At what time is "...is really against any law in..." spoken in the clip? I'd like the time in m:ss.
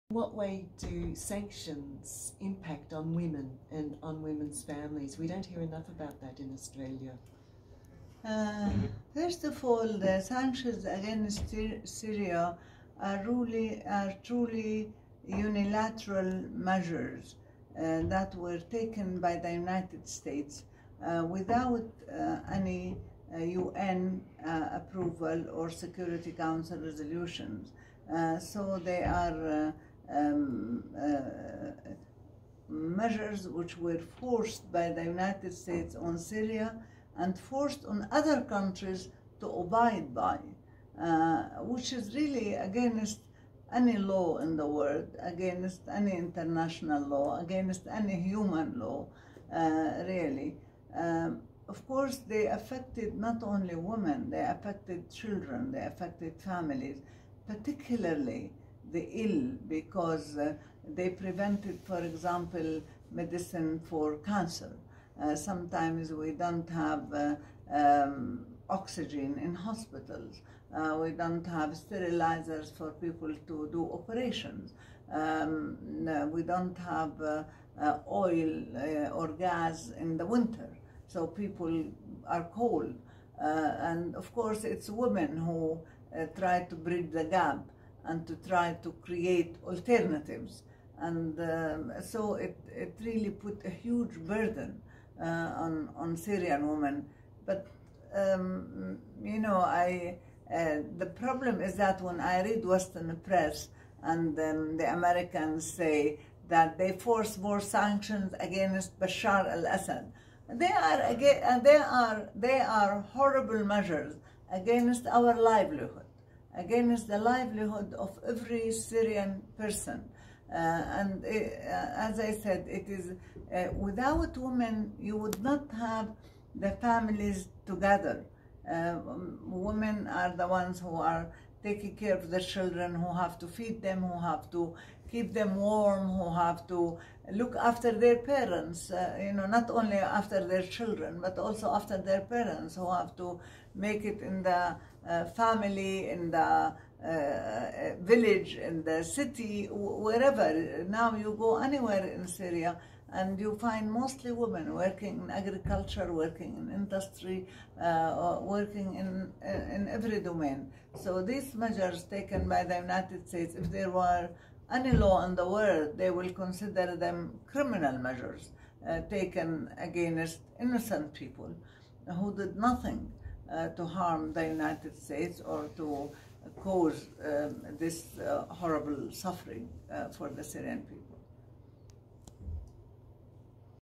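0:41.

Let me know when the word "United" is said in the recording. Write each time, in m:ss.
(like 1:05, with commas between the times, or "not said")
0:19, 0:35, 2:42, 2:54.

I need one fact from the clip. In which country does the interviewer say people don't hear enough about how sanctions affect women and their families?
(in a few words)
Australia.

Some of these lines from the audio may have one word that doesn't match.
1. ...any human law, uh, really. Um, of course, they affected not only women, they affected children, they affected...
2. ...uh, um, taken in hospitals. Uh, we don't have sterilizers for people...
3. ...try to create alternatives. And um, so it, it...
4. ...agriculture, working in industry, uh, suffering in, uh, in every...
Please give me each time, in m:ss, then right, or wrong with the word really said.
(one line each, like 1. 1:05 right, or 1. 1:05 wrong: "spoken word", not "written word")
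1. 0:47 right
2. 1:07 wrong: "oxygen", not "taken"
3. 1:28 right
4. 2:35 wrong: "working", not "suffering".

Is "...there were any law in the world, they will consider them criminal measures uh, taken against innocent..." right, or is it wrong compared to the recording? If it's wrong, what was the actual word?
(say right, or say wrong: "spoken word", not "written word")
right.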